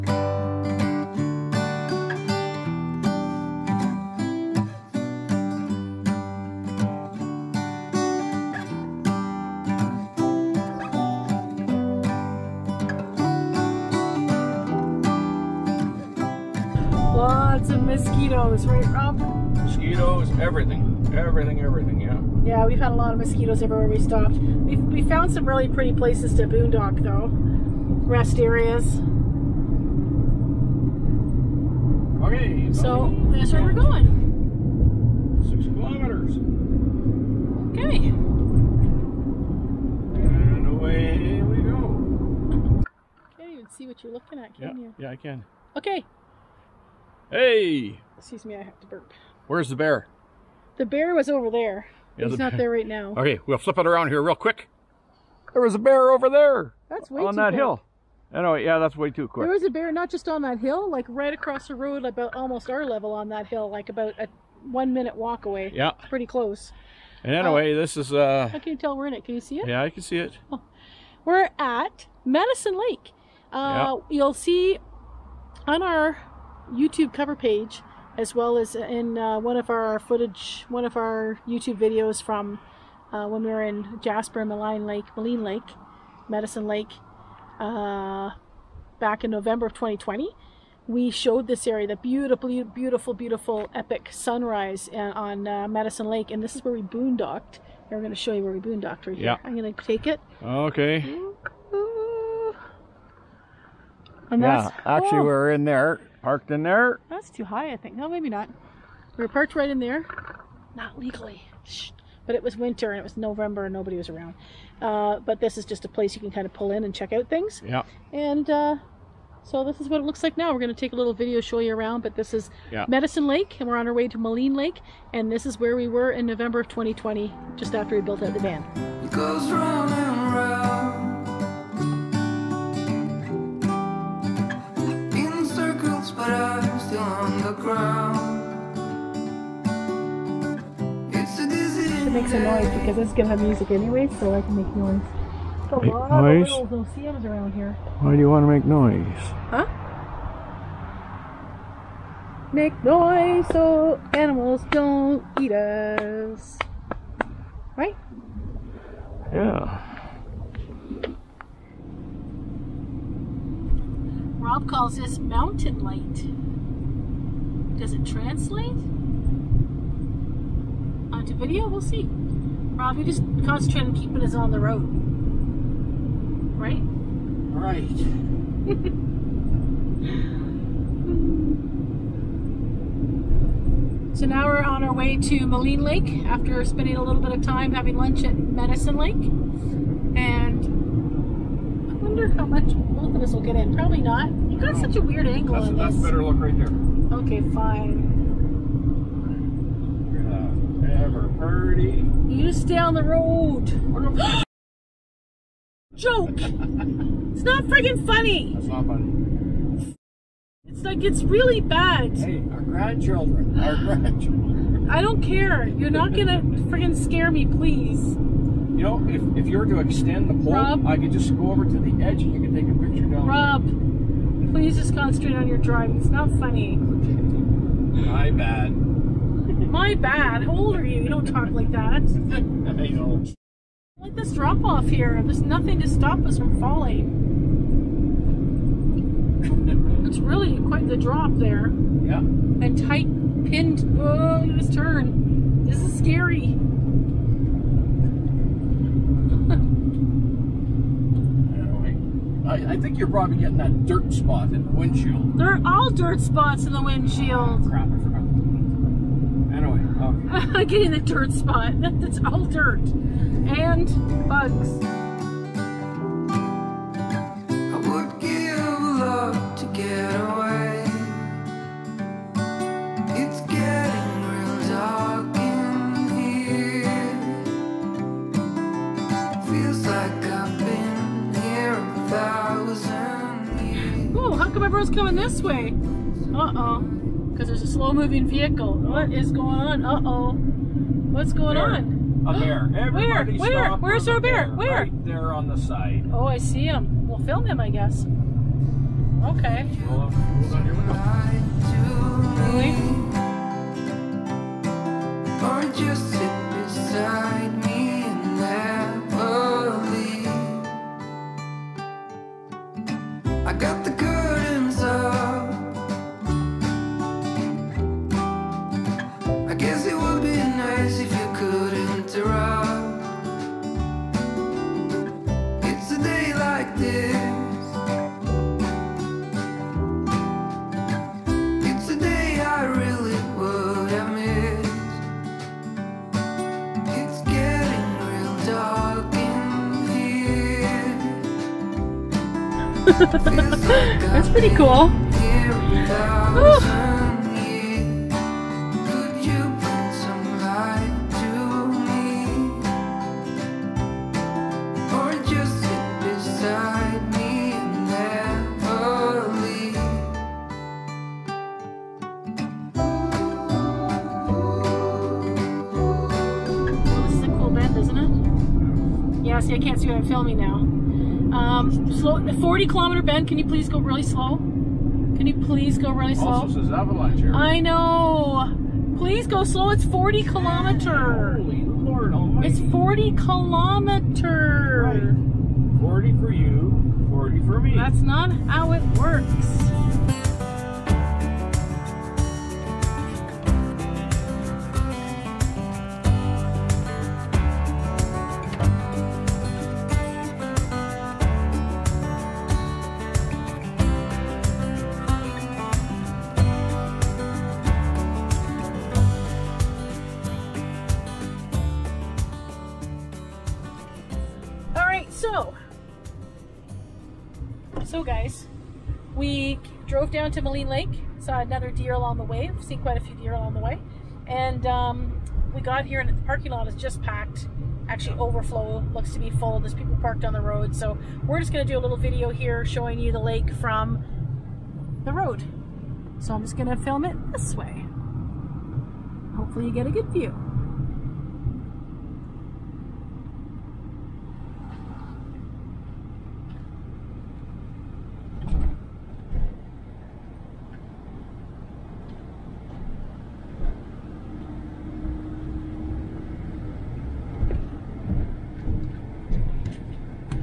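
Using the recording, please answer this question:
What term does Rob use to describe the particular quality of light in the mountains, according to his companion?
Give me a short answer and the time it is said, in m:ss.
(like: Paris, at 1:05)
mountain light, at 2:45.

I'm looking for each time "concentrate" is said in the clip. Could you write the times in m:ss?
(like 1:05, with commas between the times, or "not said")
2:53, 3:44.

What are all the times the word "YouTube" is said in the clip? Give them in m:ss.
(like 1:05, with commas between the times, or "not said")
1:16, 1:21.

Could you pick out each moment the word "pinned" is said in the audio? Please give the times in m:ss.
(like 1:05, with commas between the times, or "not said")
4:03.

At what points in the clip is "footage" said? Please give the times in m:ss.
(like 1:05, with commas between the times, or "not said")
1:19.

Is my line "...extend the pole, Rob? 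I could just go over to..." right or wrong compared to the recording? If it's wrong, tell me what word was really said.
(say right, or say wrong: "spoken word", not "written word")
right.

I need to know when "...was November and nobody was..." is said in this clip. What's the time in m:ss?
1:53.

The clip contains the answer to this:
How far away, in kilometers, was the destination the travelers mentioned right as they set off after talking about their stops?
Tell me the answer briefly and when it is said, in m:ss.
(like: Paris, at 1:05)
6 kilometers, at 0:35.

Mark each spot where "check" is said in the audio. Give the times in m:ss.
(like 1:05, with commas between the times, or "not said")
1:56.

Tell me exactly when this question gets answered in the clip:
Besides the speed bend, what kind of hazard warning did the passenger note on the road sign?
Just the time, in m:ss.
6:16.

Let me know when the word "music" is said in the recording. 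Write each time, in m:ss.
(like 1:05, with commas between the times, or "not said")
2:23.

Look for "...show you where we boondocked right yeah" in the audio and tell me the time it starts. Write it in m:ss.
1:38.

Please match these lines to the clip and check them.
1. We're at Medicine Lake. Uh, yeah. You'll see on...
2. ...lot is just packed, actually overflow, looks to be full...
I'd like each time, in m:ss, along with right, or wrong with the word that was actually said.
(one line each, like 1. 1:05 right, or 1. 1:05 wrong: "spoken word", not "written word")
1. 1:11 right
2. 7:06 right.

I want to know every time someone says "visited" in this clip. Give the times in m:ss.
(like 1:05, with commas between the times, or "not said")
not said.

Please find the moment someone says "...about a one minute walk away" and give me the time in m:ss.
1:03.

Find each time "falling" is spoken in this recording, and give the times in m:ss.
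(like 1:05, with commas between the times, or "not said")
3:56.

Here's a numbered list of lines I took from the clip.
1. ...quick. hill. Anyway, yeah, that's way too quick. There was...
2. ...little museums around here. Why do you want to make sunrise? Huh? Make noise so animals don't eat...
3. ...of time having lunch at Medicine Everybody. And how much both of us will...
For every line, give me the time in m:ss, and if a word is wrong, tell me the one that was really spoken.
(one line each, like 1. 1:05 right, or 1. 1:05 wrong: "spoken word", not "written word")
1. 0:57 right
2. 2:26 wrong: "noise", not "sunrise"
3. 3:07 wrong: "Lake", not "Everybody".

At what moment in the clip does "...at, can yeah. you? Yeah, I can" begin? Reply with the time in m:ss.
0:44.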